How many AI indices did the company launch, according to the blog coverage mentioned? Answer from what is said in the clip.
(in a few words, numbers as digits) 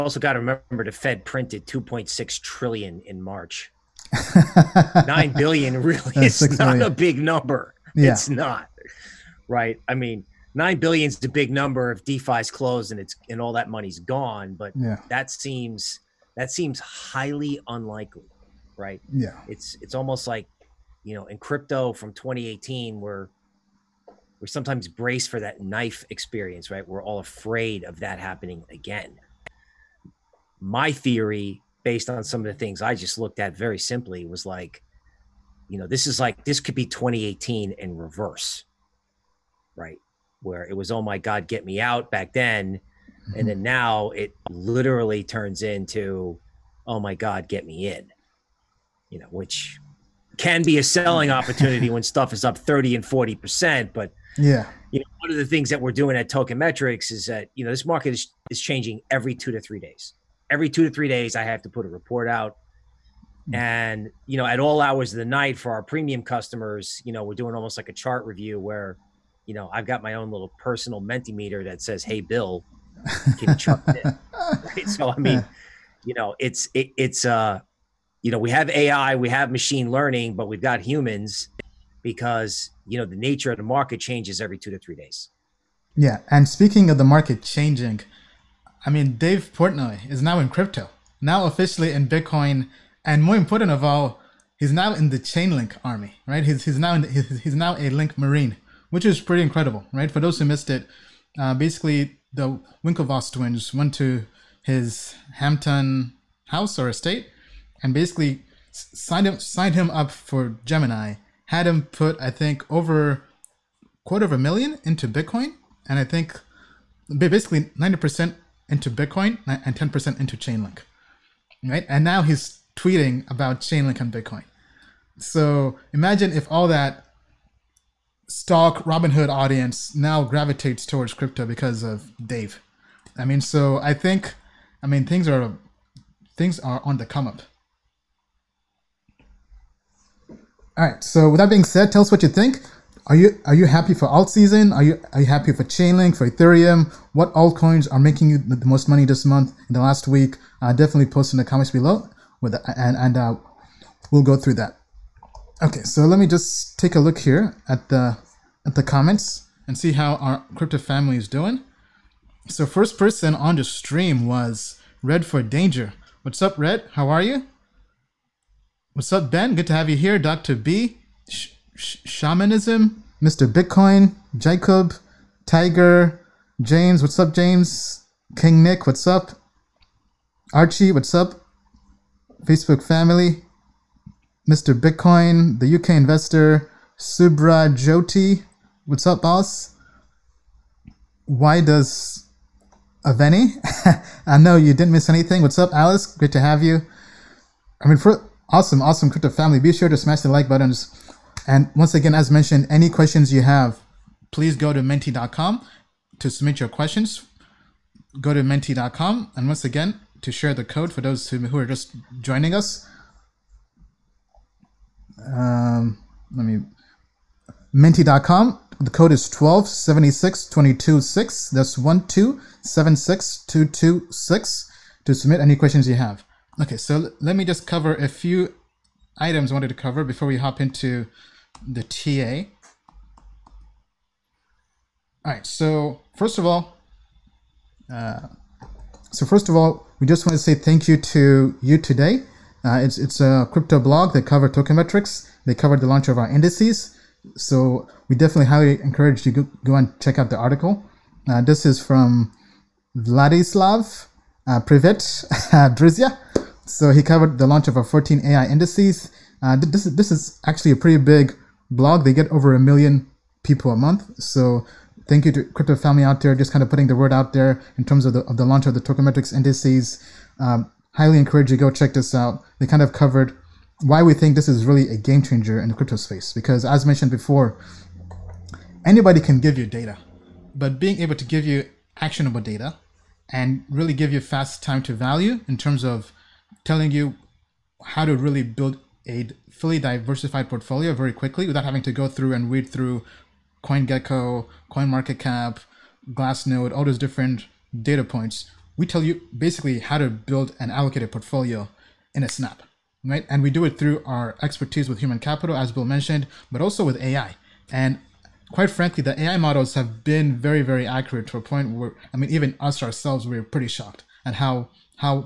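14.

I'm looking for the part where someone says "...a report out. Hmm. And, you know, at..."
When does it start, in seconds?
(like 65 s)
61 s.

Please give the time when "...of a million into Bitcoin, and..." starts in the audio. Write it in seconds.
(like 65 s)
114 s.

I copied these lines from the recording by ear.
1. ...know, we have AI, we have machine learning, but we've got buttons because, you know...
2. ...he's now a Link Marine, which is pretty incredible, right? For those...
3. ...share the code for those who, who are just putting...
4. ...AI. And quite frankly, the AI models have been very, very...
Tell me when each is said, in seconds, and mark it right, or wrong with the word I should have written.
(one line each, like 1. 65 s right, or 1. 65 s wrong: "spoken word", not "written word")
1. 78 s wrong: "humans", not "buttons"
2. 97 s right
3. 210 s wrong: "joining", not "putting"
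4. 307 s right.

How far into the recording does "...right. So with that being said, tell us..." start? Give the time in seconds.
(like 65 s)
140 s.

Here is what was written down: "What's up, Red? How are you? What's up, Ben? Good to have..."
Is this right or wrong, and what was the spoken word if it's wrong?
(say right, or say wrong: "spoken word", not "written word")
right.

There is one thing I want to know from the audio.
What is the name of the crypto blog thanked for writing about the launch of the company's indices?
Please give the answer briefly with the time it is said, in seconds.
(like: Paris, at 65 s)
U.Today, at 241 s.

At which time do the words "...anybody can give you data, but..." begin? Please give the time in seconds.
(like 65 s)
278 s.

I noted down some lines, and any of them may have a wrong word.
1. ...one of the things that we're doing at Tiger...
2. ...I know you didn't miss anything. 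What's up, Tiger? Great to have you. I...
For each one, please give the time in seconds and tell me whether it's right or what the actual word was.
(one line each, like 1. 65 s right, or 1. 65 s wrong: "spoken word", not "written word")
1. 55 s wrong: "Token", not "Tiger"
2. 194 s wrong: "Alice", not "Tiger".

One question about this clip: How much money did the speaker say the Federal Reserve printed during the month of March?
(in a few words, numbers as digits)
2.6 trillion.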